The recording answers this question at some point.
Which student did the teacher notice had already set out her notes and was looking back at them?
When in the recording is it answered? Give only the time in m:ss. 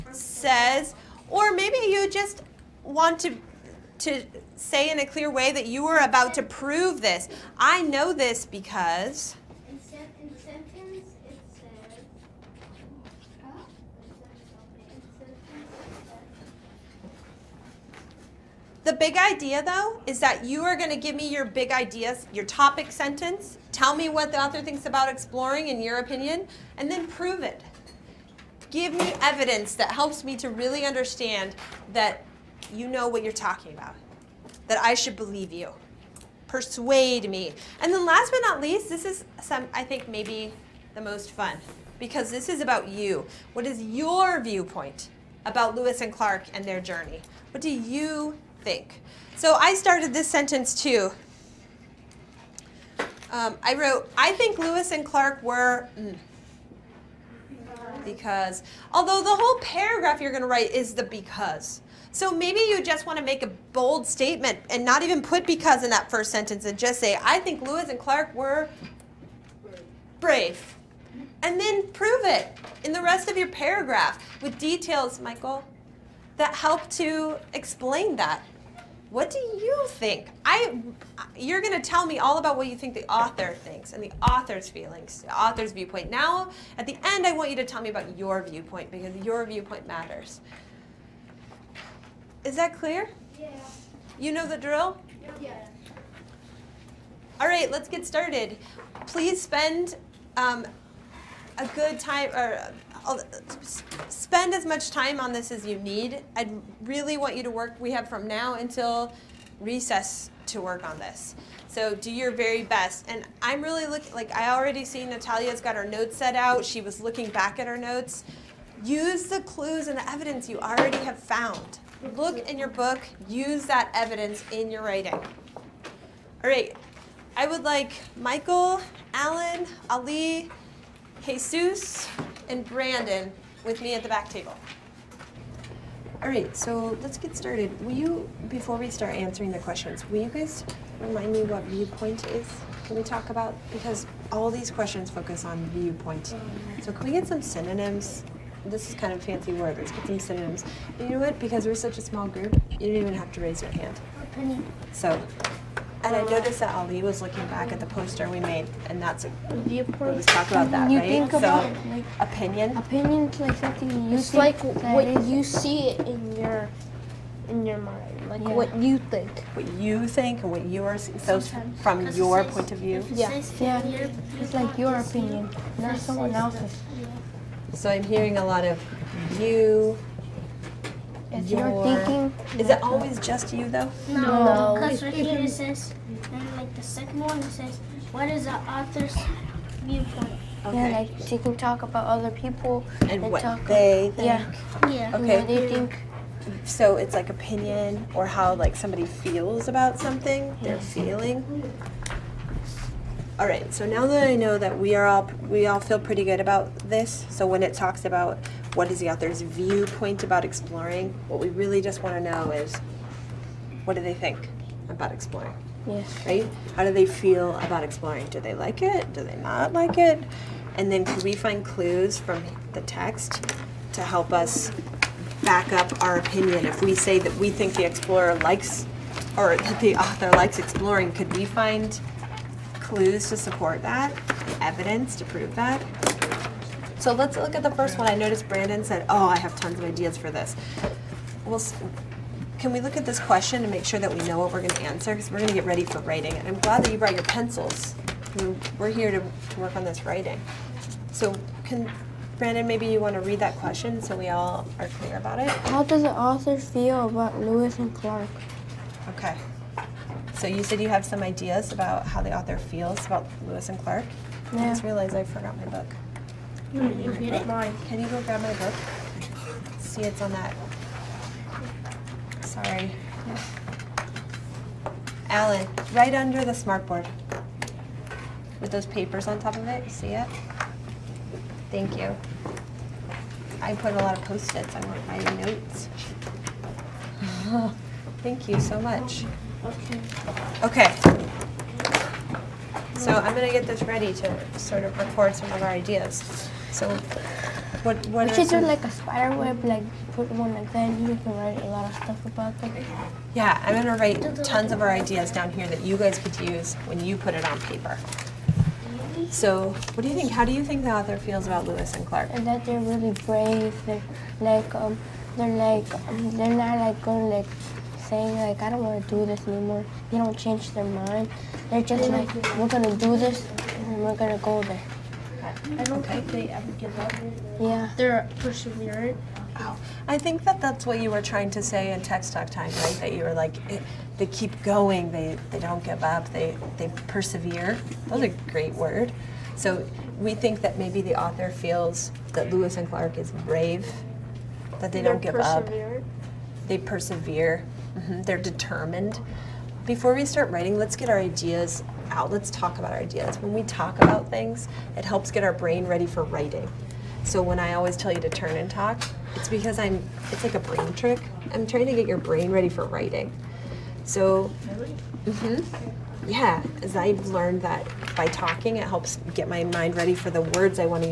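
1:55.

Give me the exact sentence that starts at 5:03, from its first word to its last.
Yeah, I'm gonna write tons of our ideas down here that you guys could use when you put it on paper.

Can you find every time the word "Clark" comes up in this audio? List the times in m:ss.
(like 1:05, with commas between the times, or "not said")
0:46, 0:55, 1:07, 4:17, 4:23, 5:12, 5:42.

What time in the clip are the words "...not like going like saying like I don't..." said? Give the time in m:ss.
5:16.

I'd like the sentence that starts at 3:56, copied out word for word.
So let's look at the first one.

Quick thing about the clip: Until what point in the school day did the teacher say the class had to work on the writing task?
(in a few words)
recess.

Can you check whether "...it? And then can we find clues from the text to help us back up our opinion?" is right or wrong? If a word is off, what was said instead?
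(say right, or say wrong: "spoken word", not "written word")
right.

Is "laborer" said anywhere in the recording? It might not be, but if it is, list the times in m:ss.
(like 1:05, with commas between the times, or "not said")
not said.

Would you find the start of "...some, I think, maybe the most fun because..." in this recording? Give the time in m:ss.
0:39.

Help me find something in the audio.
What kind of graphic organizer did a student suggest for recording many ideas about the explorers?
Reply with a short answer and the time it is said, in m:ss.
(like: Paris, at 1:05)
spider web, at 4:58.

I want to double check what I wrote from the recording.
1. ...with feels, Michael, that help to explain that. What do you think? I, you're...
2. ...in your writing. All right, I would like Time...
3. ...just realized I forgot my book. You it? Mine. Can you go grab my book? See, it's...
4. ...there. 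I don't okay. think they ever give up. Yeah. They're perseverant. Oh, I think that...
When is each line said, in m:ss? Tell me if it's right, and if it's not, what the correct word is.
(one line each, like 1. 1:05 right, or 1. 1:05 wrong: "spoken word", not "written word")
1. 1:14 wrong: "details", not "feels"
2. 2:04 wrong: "Michael", not "Time"
3. 4:24 right
4. 5:24 right.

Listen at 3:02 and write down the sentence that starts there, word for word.
Is it always just you though?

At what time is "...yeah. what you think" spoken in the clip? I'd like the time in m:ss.
2:48.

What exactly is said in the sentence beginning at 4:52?
So I'm going to get this ready to sort of record some of our ideas.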